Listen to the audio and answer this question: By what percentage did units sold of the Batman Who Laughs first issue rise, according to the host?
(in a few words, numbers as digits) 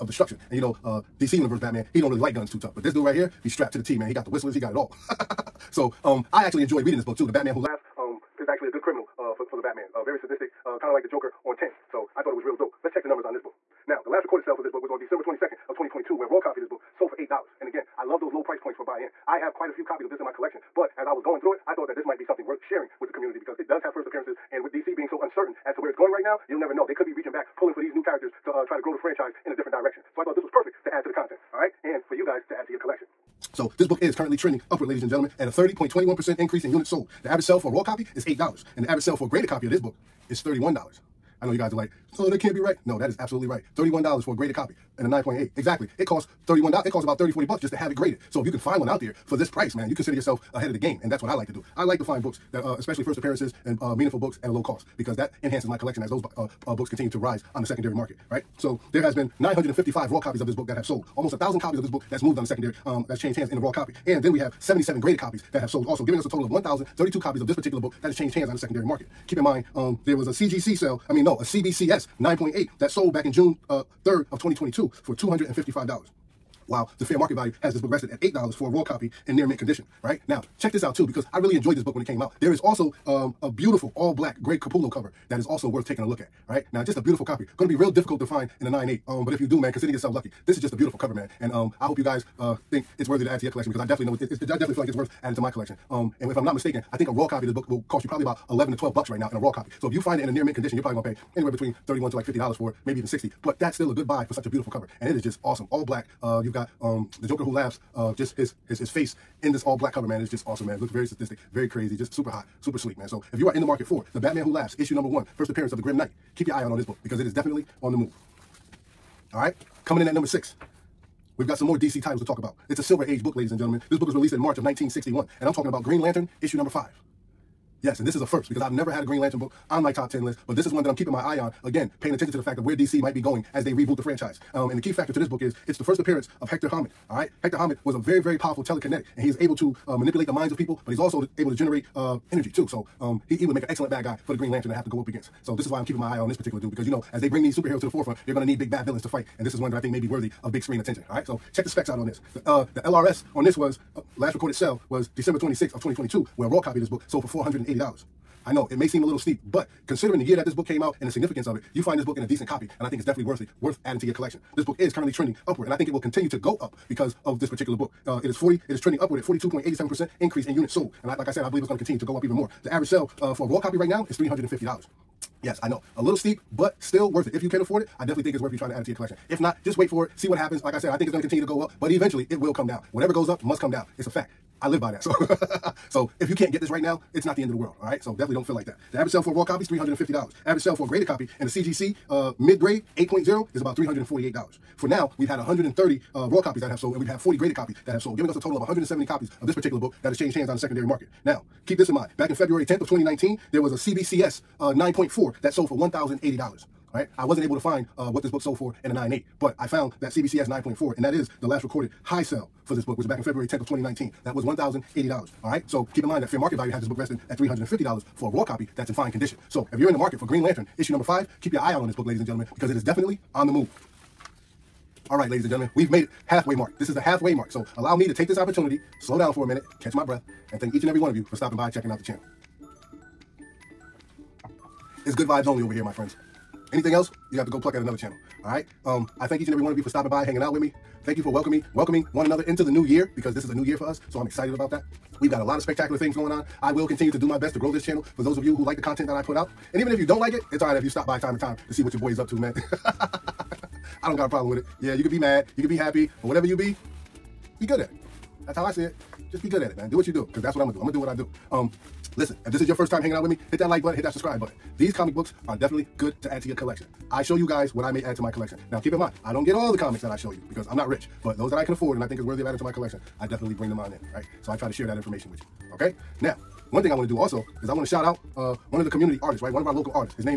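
30.21%.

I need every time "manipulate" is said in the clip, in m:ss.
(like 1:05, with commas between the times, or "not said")
2:19.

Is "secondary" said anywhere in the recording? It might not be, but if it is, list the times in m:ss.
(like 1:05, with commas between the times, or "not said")
0:57, 1:02, 1:08, 3:20.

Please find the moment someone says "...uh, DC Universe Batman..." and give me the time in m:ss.
0:00.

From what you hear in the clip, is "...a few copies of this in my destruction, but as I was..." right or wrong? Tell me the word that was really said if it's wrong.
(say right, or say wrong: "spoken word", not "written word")
wrong: "collection", not "destruction".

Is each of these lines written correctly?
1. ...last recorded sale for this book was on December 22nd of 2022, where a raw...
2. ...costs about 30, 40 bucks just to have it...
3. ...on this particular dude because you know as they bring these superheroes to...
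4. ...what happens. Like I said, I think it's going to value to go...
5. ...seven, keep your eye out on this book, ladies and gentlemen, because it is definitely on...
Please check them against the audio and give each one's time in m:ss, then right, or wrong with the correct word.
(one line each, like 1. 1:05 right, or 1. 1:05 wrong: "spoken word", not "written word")
1. 0:14 right
2. 0:46 right
3. 2:26 right
4. 3:00 wrong: "continue", not "value"
5. 3:41 wrong: "five", not "seven".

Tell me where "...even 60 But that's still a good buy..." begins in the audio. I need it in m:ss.
1:42.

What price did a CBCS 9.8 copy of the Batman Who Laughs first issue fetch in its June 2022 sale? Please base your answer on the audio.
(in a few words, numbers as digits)
$255.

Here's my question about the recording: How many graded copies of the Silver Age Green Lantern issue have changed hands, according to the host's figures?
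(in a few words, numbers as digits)
40.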